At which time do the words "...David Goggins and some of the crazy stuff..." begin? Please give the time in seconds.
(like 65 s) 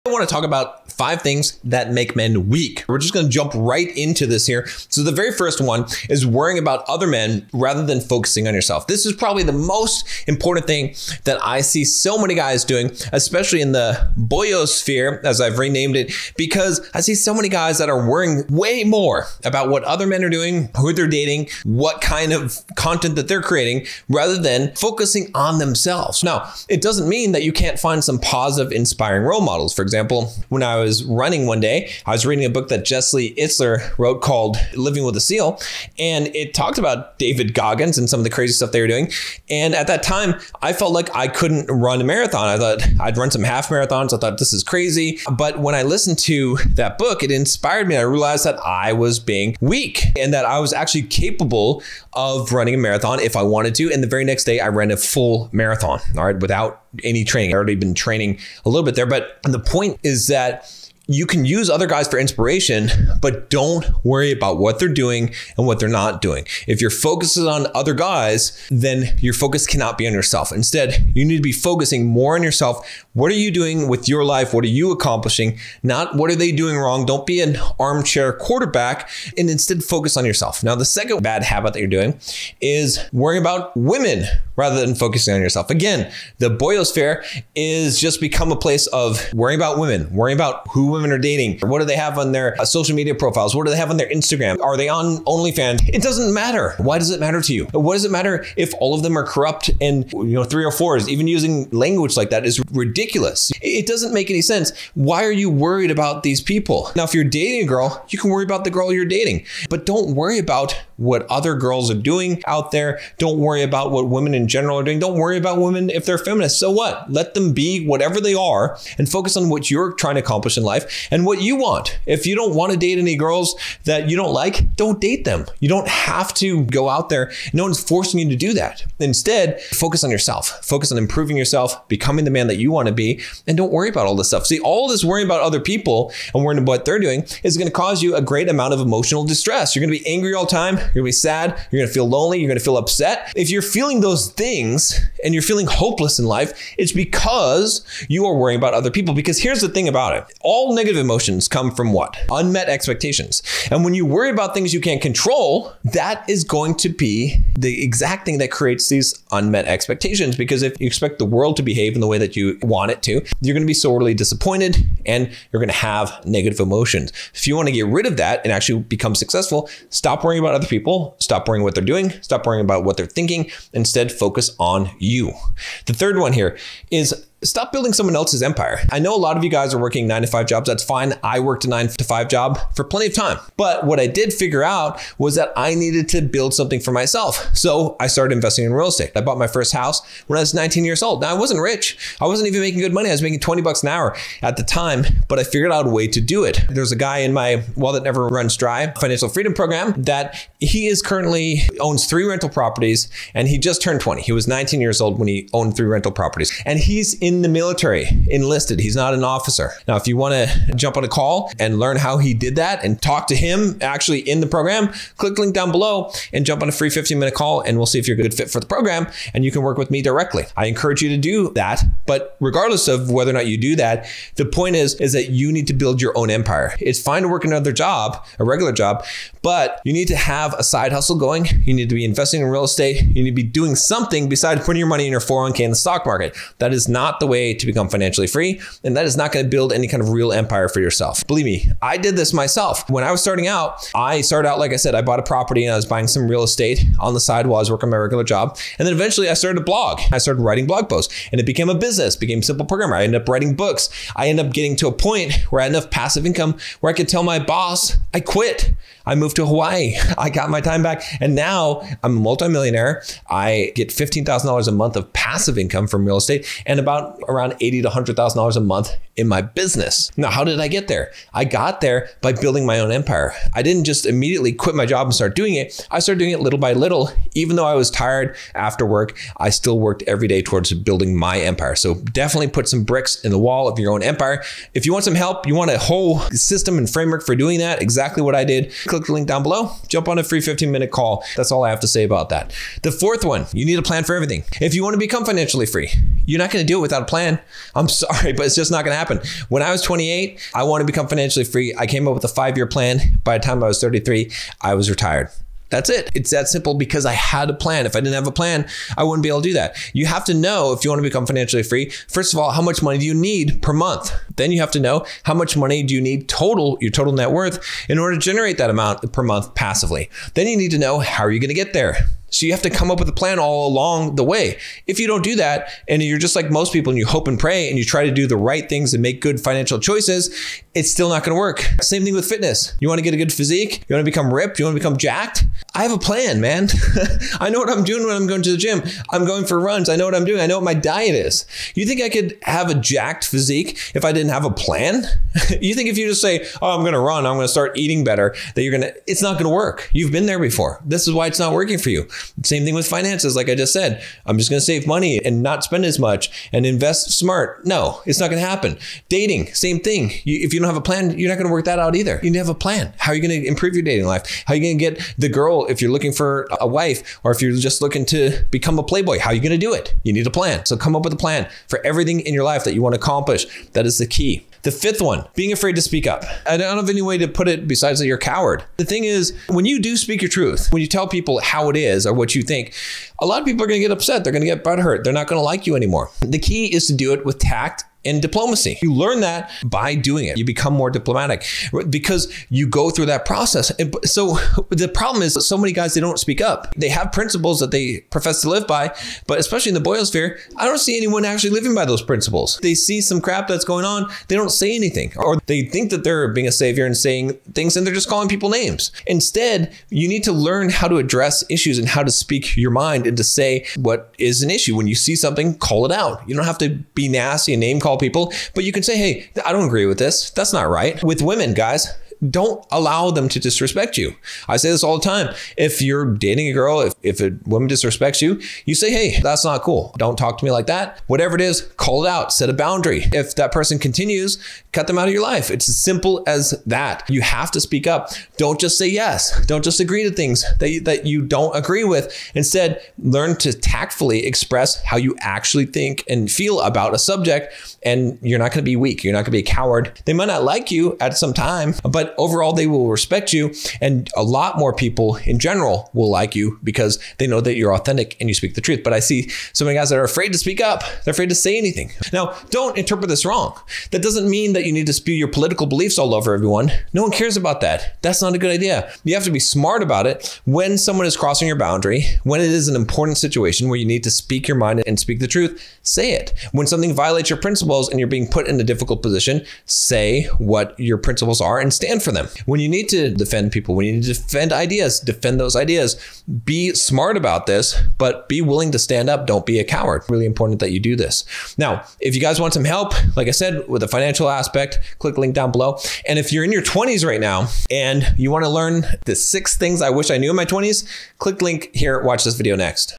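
37 s.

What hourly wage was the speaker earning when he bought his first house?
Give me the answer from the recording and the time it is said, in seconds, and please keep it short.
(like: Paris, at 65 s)
$20 an hour, at 193 s.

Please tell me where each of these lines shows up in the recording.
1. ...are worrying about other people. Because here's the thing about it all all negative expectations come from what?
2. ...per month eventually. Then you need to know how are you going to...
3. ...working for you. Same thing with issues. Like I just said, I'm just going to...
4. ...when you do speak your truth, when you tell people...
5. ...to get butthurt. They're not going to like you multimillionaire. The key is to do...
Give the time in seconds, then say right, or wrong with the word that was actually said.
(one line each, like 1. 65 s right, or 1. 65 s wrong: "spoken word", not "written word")
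1. 148 s wrong: "emotions", not "expectations"
2. 319 s wrong: "passively", not "eventually"
3. 351 s wrong: "finances", not "issues"
4. 379 s right
5. 384 s wrong: "anymore", not "multimillionaire".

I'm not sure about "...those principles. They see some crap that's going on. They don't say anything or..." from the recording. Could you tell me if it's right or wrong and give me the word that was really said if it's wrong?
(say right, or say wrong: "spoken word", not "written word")
right.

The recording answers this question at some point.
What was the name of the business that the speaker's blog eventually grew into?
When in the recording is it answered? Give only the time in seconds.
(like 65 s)
252 s.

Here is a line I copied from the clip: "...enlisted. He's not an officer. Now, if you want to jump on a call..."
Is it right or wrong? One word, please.
right.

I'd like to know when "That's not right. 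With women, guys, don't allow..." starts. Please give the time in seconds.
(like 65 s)
420 s.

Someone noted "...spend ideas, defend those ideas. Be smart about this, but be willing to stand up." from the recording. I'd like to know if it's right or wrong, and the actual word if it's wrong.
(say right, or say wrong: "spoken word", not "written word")
wrong: "defend", not "spend".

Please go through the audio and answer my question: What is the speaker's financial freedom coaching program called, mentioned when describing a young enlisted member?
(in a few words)
Well that never runs dry.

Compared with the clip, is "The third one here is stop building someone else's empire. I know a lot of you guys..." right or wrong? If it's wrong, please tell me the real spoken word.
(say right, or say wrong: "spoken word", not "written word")
right.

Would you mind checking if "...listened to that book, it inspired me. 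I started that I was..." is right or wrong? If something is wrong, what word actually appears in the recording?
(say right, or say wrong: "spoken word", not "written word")
wrong: "realized", not "started".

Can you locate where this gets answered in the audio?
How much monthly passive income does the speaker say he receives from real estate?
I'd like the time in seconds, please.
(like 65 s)
263 s.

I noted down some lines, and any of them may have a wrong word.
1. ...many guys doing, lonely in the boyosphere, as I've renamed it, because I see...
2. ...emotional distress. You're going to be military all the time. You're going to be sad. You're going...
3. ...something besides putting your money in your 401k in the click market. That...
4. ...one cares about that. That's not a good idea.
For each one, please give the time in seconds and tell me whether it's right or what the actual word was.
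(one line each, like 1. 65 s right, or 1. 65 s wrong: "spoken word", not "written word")
1. 12 s wrong: "especially", not "lonely"
2. 138 s wrong: "angry", not "military"
3. 233 s wrong: "stock", not "click"
4. 467 s right.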